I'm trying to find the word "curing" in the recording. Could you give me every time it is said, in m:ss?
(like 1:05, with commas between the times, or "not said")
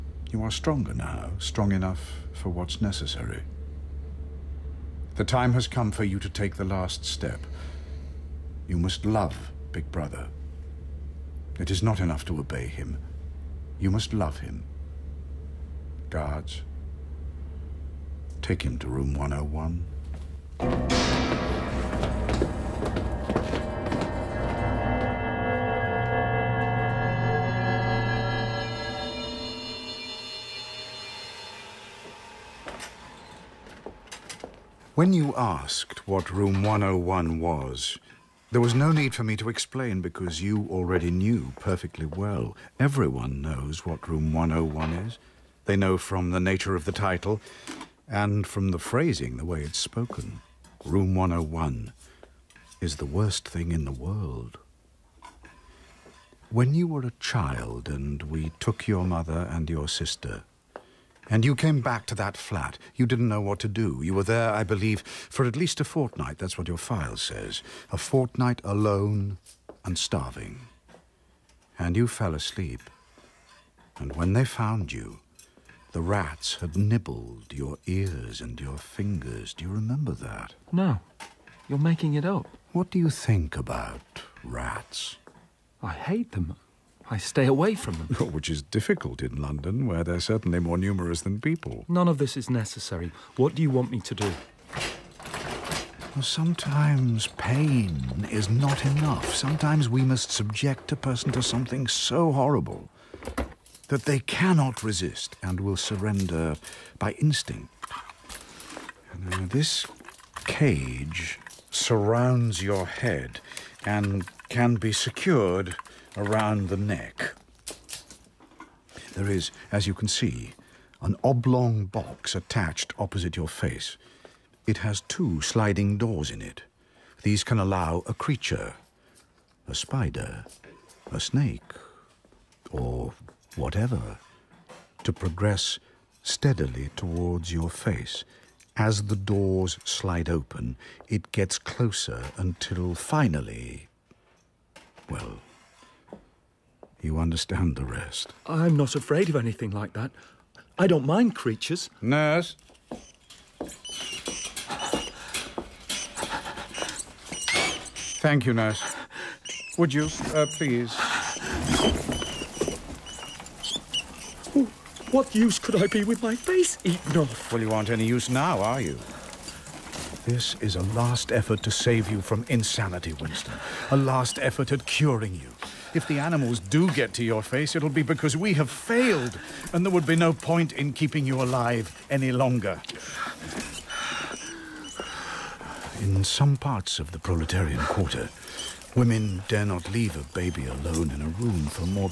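2:54.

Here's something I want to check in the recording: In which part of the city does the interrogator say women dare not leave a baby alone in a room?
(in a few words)
the proletarian quarter.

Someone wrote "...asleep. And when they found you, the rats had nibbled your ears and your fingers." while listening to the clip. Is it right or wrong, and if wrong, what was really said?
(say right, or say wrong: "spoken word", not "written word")
right.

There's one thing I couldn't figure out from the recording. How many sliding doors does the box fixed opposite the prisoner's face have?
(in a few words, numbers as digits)
2.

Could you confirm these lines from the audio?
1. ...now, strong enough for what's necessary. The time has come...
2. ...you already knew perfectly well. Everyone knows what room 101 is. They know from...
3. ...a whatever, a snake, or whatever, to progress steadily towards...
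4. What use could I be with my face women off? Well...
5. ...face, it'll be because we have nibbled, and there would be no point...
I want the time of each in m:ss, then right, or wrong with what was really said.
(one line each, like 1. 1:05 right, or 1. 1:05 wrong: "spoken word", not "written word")
1. 0:00 right
2. 0:40 right
3. 2:09 wrong: "spider", not "whatever"
4. 2:45 wrong: "eaten", not "women"
5. 2:57 wrong: "failed", not "nibbled".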